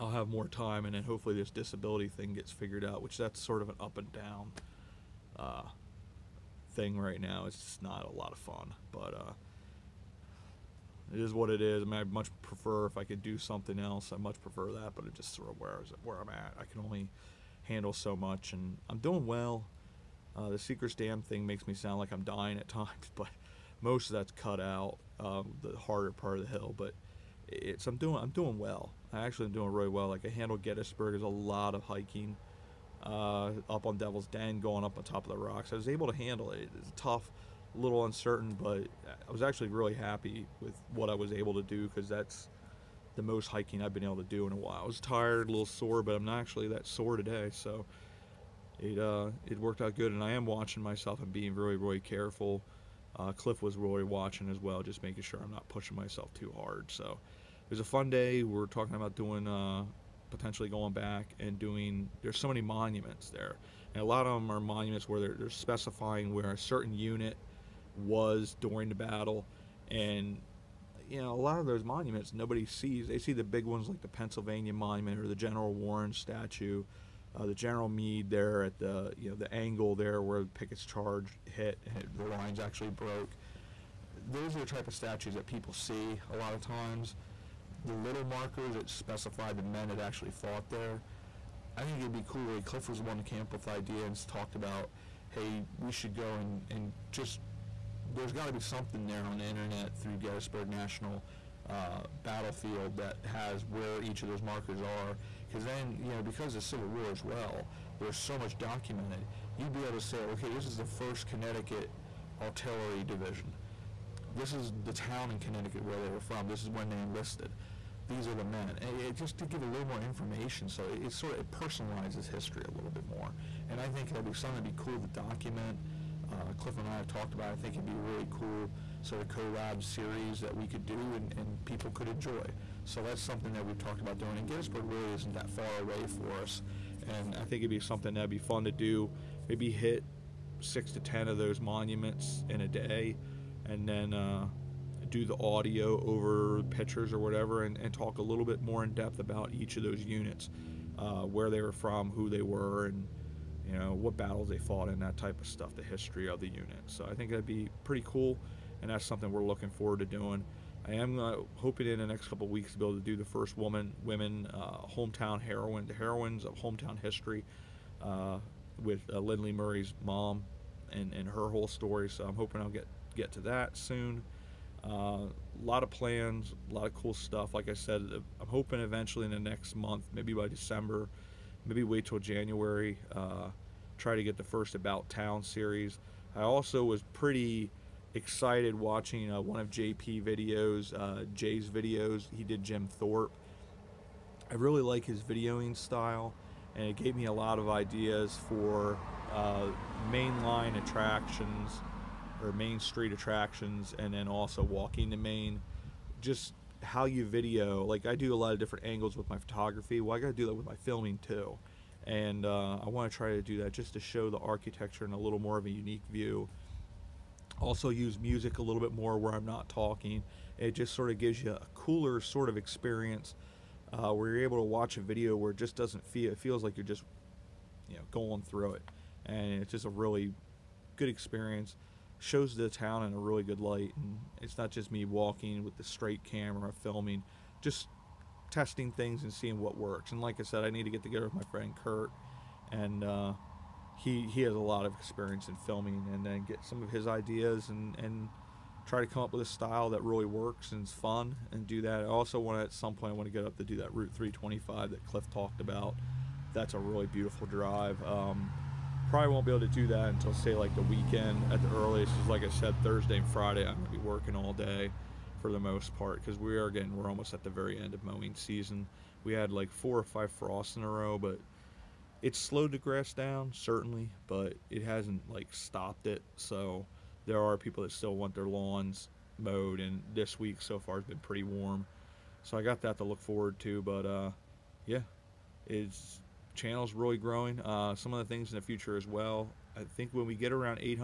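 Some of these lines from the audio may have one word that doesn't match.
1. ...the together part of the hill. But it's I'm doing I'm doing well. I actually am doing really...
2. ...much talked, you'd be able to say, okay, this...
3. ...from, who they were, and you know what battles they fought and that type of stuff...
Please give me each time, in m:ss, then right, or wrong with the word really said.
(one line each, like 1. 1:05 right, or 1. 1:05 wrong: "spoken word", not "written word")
1. 0:25 wrong: "harder", not "together"
2. 1:48 wrong: "documented", not "talked"
3. 2:31 right.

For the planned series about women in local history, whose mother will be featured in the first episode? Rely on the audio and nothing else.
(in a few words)
Lindley Murray.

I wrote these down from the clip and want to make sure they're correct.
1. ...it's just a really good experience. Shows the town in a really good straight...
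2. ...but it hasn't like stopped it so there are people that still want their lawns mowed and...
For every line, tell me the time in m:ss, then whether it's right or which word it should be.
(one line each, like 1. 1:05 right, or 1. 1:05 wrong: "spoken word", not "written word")
1. 3:49 wrong: "light", not "straight"
2. 4:34 right.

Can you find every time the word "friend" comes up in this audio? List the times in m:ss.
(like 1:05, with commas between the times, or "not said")
4:01.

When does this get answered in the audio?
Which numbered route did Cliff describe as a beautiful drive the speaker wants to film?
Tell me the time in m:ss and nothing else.
4:13.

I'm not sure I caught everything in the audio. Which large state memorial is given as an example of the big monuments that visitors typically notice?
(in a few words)
Pennsylvania Monument.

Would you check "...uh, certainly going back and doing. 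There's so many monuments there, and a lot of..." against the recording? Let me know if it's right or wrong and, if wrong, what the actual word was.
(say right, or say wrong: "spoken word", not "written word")
wrong: "potentially", not "certainly".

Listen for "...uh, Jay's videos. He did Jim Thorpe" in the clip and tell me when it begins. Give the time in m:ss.
3:10.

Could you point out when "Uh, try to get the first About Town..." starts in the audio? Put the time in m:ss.
3:03.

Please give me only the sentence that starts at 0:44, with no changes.
I was tired, a little sore, but I'm not actually that sore today.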